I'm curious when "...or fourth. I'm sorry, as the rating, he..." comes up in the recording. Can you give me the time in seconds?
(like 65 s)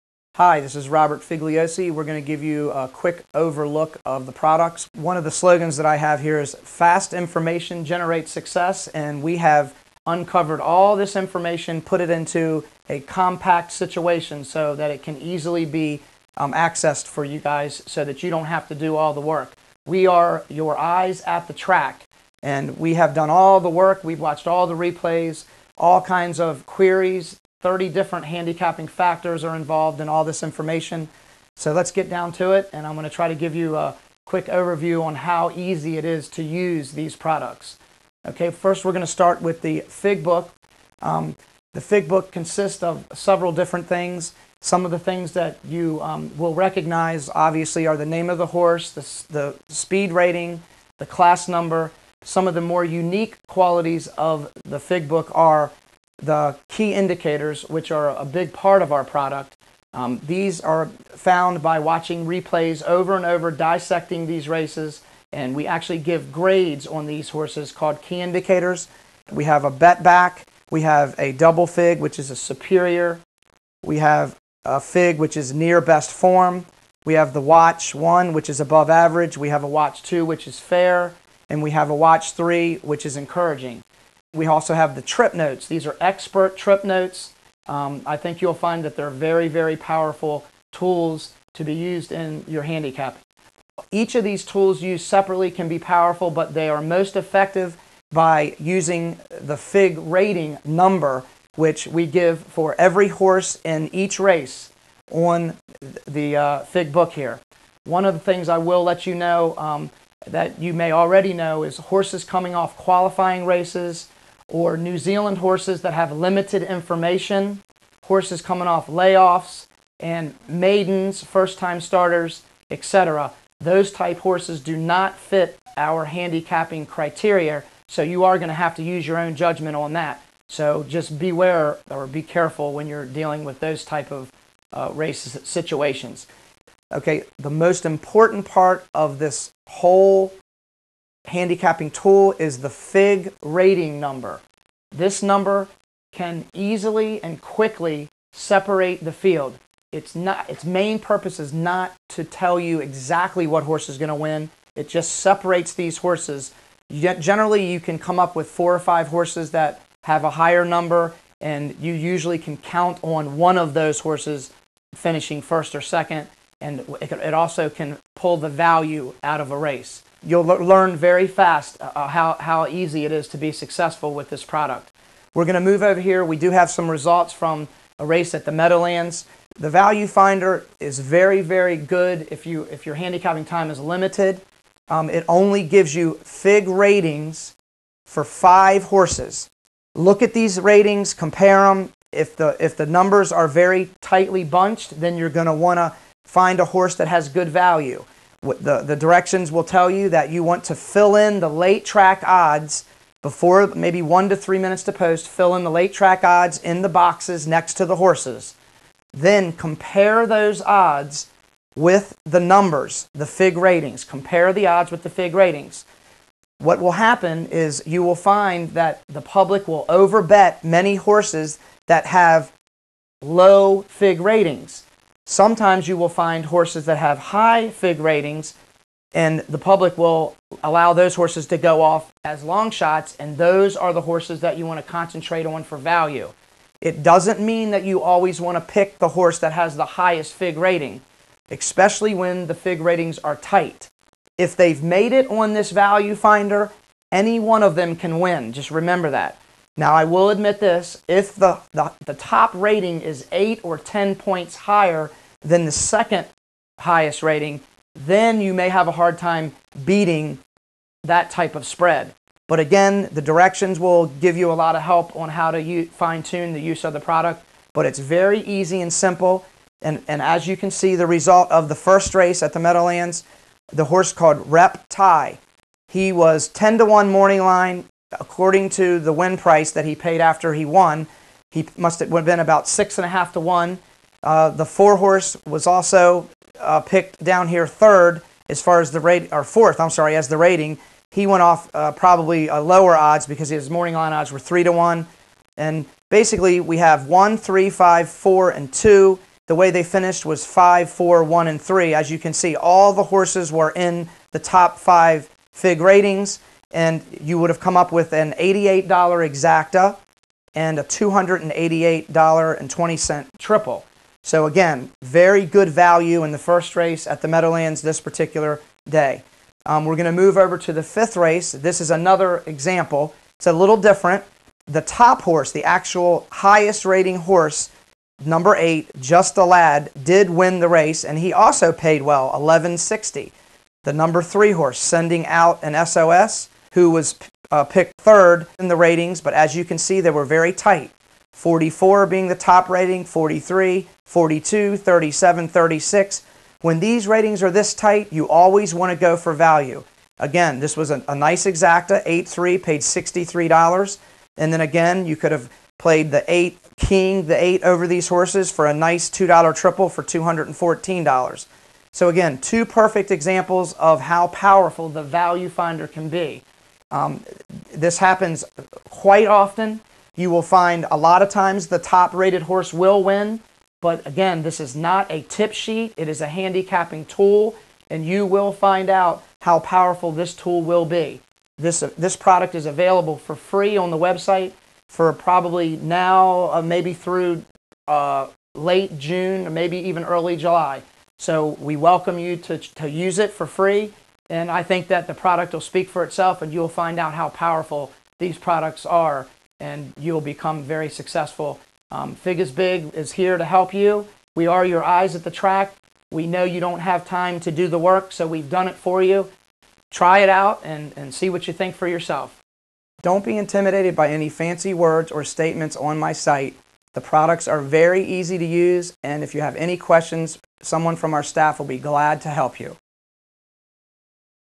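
289 s.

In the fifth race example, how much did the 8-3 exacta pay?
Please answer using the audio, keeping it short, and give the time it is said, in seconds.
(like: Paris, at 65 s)
$63, at 352 s.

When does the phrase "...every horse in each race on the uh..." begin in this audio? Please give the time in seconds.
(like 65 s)
102 s.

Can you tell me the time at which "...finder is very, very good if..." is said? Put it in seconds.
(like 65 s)
180 s.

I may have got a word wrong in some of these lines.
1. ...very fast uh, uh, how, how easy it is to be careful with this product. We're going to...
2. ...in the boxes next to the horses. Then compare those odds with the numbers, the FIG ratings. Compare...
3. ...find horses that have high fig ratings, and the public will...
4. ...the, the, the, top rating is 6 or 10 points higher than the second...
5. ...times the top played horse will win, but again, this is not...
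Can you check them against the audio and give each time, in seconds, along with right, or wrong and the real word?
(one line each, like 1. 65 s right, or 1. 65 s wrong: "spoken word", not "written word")
1. 170 s wrong: "successful", not "careful"
2. 206 s right
3. 226 s right
4. 251 s wrong: "8", not "6"
5. 371 s wrong: "rated", not "played".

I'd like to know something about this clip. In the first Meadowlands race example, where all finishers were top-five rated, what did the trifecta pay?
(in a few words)
$288.20.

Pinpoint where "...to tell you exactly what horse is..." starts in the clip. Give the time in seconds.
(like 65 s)
152 s.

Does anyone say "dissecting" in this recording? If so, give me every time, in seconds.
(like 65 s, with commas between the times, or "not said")
63 s.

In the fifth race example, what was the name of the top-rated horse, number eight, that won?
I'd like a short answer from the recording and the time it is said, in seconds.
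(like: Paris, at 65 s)
Just a Lad, at 328 s.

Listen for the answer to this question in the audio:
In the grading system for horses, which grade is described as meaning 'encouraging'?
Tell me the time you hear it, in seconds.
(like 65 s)
81 s.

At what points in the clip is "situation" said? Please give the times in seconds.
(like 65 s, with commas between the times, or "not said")
13 s, 135 s.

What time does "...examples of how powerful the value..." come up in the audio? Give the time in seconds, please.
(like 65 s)
363 s.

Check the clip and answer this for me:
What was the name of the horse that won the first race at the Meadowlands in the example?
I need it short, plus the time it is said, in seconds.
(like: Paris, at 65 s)
Rep Tie, at 274 s.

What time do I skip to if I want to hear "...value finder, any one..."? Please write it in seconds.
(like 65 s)
245 s.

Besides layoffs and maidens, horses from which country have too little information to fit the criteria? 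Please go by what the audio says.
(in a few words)
New Zealand.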